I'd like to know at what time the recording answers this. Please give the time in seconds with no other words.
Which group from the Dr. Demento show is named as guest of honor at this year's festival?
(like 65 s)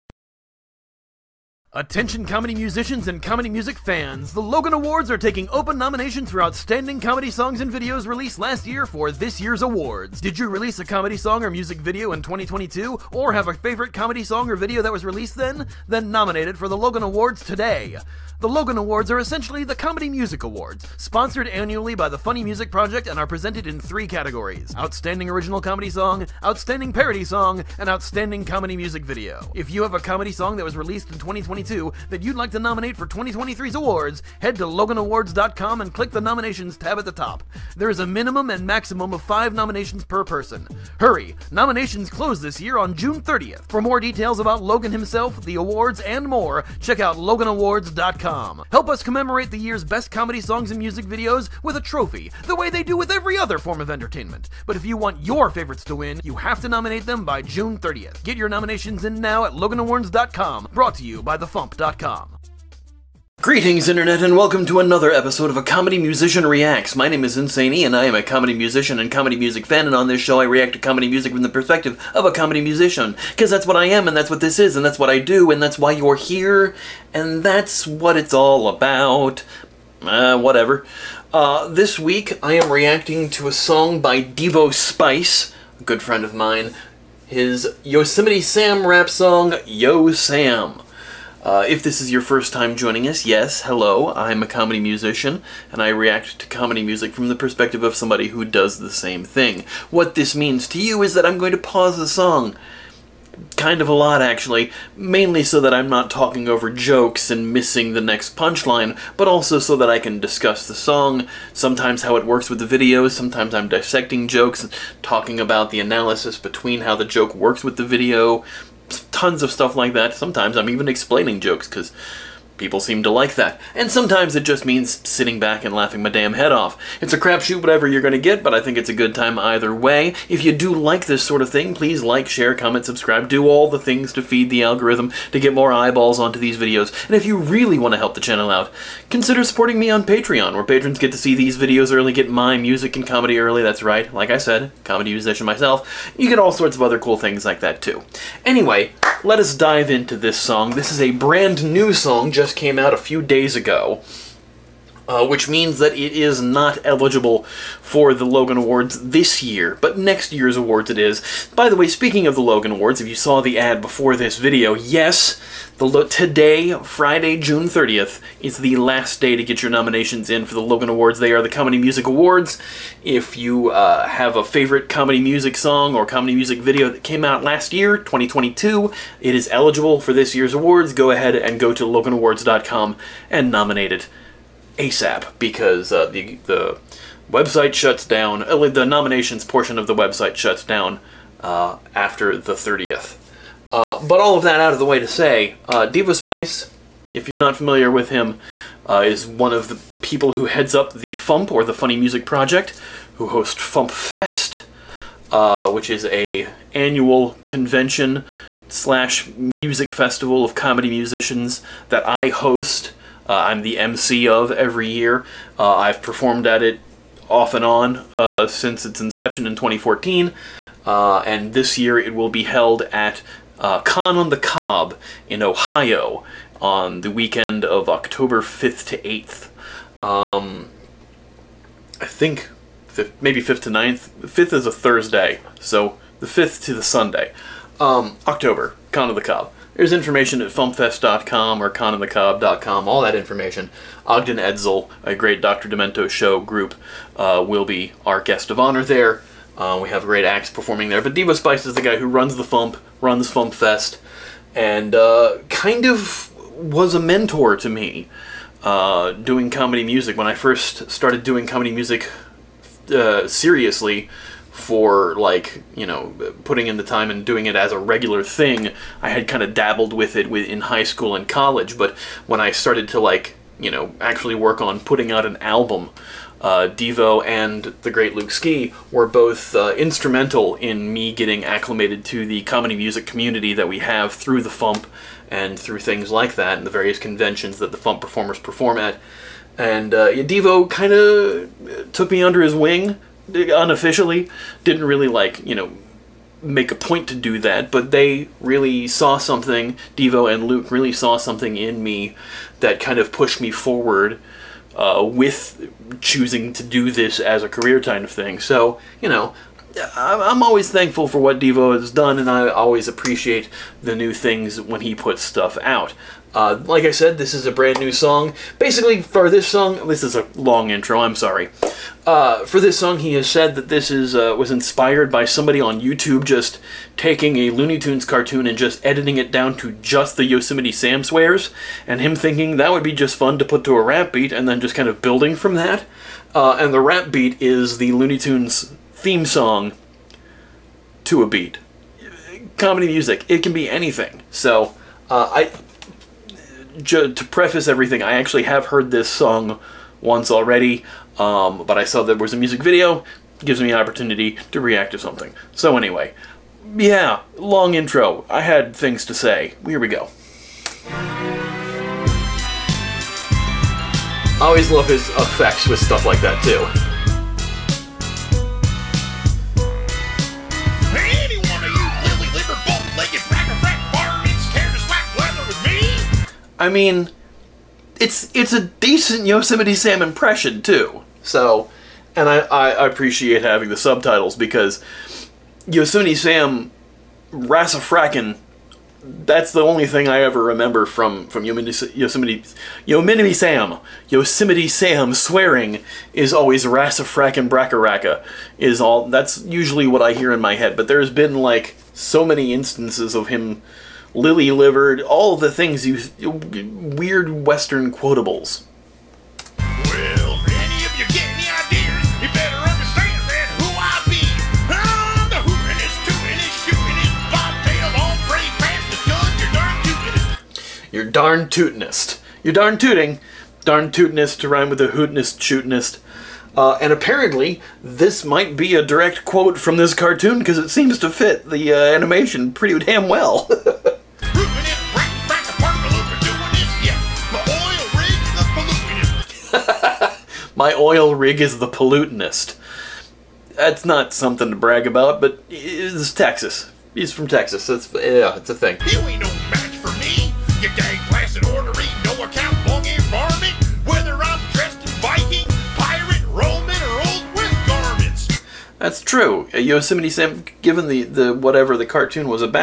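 244 s.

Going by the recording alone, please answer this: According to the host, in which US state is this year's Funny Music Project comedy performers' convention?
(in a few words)
Ohio.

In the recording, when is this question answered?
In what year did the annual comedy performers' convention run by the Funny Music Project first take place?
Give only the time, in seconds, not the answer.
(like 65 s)
219 s.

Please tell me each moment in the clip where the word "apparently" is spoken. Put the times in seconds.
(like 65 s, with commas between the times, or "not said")
426 s.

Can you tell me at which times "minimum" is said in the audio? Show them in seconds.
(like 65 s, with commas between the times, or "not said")
38 s.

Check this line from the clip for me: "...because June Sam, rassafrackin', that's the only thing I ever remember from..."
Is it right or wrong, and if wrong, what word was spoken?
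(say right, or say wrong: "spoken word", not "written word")
wrong: "Yosemite", not "June".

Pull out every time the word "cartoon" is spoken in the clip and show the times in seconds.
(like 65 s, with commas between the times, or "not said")
328 s, 429 s, 461 s.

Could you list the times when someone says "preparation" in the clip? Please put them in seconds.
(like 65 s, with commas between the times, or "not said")
not said.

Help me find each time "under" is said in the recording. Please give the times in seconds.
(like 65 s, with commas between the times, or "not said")
292 s.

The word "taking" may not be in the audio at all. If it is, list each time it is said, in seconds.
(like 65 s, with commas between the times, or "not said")
5 s, 326 s.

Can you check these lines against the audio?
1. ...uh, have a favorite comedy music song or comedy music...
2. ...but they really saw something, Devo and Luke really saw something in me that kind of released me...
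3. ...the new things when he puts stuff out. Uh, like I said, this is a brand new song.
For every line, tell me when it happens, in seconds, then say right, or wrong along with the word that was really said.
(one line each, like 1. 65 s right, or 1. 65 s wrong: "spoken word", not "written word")
1. 173 s right
2. 297 s wrong: "pushed", not "released"
3. 313 s right.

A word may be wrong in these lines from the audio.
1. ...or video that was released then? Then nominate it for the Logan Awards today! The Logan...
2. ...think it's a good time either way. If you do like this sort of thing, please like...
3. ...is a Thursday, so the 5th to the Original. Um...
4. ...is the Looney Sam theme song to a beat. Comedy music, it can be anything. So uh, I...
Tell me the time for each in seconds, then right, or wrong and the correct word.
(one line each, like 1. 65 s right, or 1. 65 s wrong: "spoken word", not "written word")
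1. 14 s right
2. 128 s right
3. 234 s wrong: "Sunday", not "Original"
4. 337 s wrong: "Tunes", not "Sam".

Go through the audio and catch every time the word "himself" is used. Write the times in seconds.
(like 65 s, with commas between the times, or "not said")
44 s.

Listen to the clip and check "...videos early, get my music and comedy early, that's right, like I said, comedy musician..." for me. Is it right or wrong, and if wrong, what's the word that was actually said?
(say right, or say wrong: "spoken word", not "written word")
right.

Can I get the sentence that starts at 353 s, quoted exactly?
gives me an opportunity to react to something.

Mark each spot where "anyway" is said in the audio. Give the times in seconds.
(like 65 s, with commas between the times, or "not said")
148 s, 355 s.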